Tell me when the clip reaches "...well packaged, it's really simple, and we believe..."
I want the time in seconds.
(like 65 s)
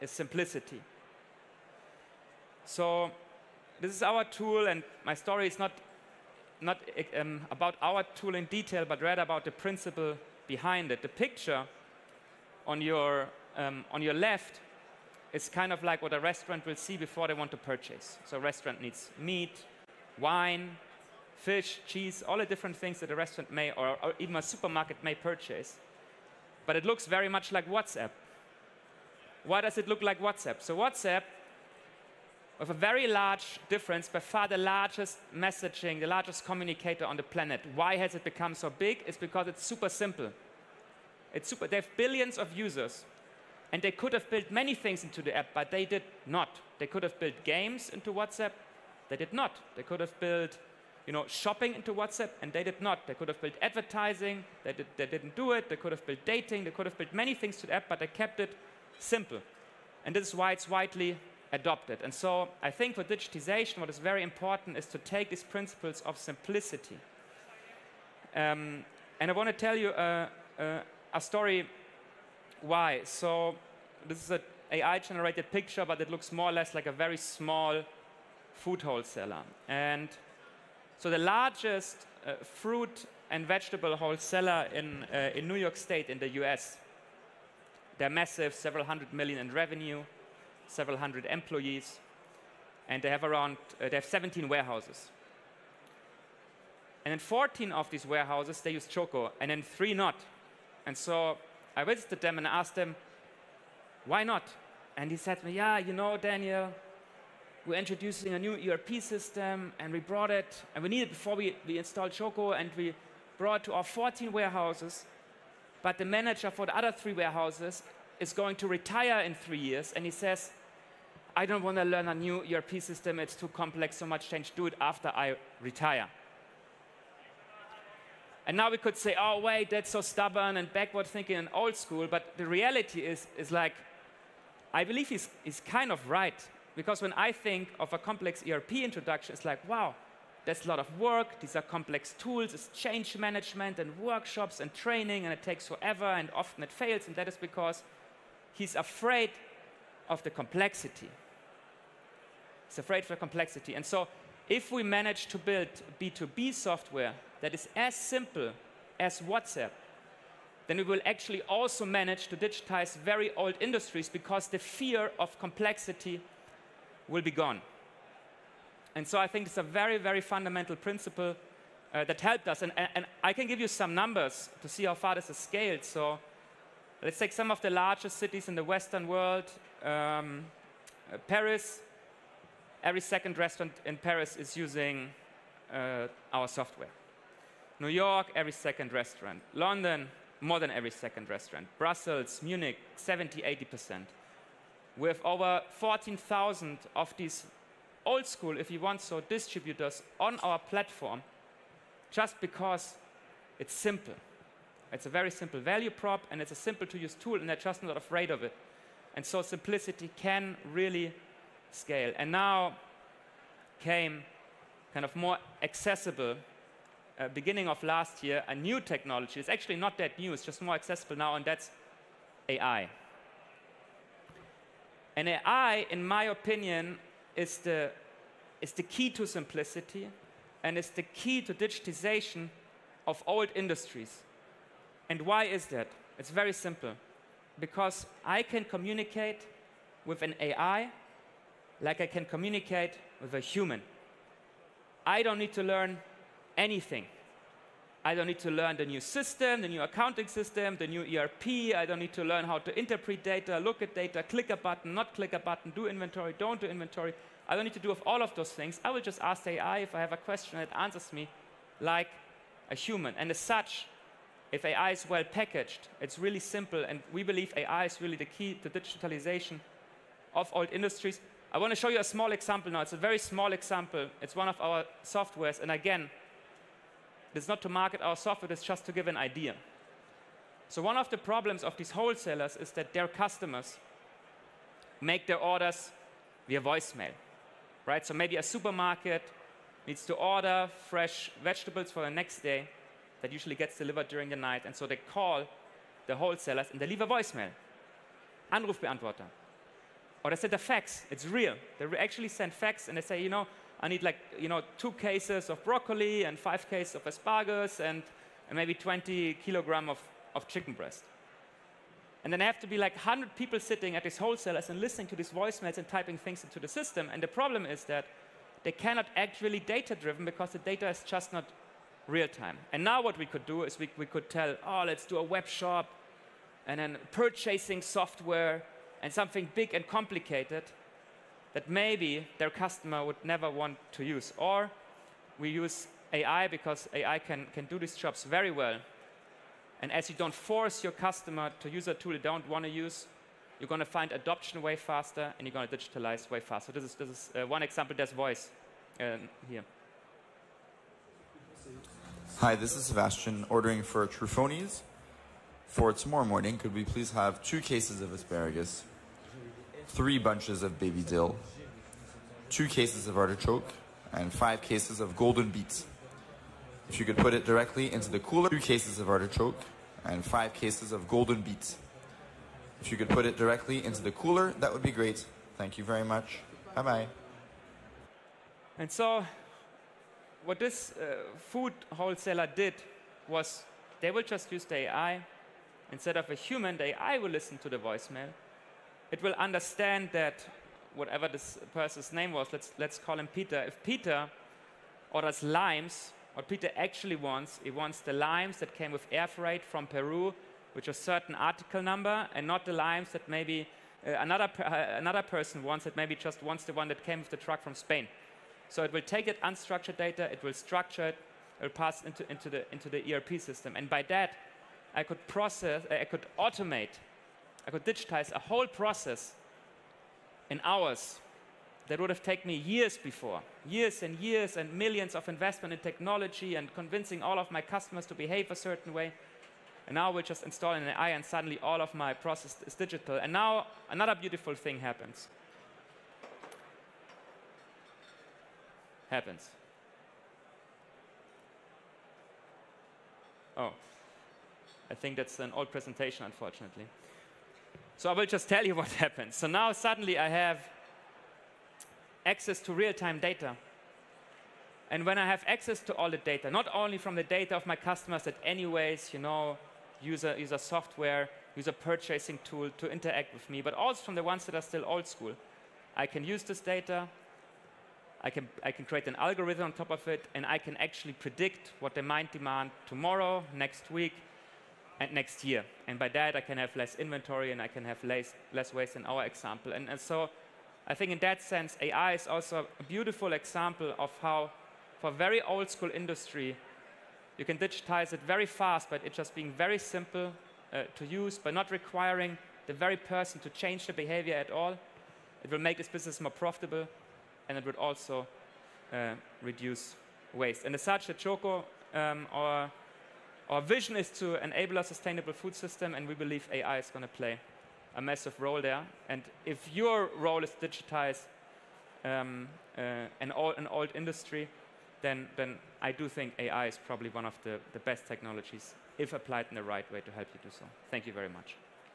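265 s.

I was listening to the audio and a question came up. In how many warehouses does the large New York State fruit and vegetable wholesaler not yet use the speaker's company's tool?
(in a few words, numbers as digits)
3.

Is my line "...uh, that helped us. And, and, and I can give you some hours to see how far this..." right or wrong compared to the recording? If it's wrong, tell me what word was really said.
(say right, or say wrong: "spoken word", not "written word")
wrong: "numbers", not "hours".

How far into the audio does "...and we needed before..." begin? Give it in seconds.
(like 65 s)
110 s.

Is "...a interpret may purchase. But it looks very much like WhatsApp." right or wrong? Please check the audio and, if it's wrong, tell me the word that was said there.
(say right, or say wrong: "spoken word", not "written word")
wrong: "supermarket", not "interpret".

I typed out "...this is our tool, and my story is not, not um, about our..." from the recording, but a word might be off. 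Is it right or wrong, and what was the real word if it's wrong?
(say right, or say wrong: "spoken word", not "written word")
right.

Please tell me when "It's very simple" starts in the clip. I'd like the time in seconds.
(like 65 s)
236 s.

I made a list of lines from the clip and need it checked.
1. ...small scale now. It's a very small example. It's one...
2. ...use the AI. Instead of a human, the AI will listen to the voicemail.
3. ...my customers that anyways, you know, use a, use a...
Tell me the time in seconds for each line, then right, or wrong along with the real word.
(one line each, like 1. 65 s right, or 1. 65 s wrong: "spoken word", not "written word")
1. 272 s wrong: "example", not "scale"
2. 384 s right
3. 457 s right.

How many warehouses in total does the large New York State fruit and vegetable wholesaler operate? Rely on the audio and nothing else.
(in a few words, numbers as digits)
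17.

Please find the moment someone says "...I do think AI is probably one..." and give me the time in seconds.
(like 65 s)
515 s.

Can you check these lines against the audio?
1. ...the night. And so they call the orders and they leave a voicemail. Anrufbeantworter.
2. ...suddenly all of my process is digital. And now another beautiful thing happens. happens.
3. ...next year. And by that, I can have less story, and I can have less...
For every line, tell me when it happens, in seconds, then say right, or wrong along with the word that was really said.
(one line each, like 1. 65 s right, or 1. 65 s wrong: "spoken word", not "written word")
1. 294 s wrong: "wholesalers", not "orders"
2. 431 s right
3. 475 s wrong: "inventory", not "story".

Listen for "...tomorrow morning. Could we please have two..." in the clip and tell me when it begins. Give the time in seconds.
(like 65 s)
355 s.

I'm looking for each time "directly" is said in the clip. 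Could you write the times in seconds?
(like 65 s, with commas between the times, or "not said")
367 s, 373 s.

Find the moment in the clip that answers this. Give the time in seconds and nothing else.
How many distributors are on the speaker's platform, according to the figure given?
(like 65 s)
195 s.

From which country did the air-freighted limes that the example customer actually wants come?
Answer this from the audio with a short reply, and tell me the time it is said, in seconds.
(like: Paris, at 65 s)
Peru, at 399 s.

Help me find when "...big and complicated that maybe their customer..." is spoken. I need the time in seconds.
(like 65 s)
329 s.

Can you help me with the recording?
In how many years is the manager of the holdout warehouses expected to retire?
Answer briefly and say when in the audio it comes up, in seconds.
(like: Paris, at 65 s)
3 years, at 118 s.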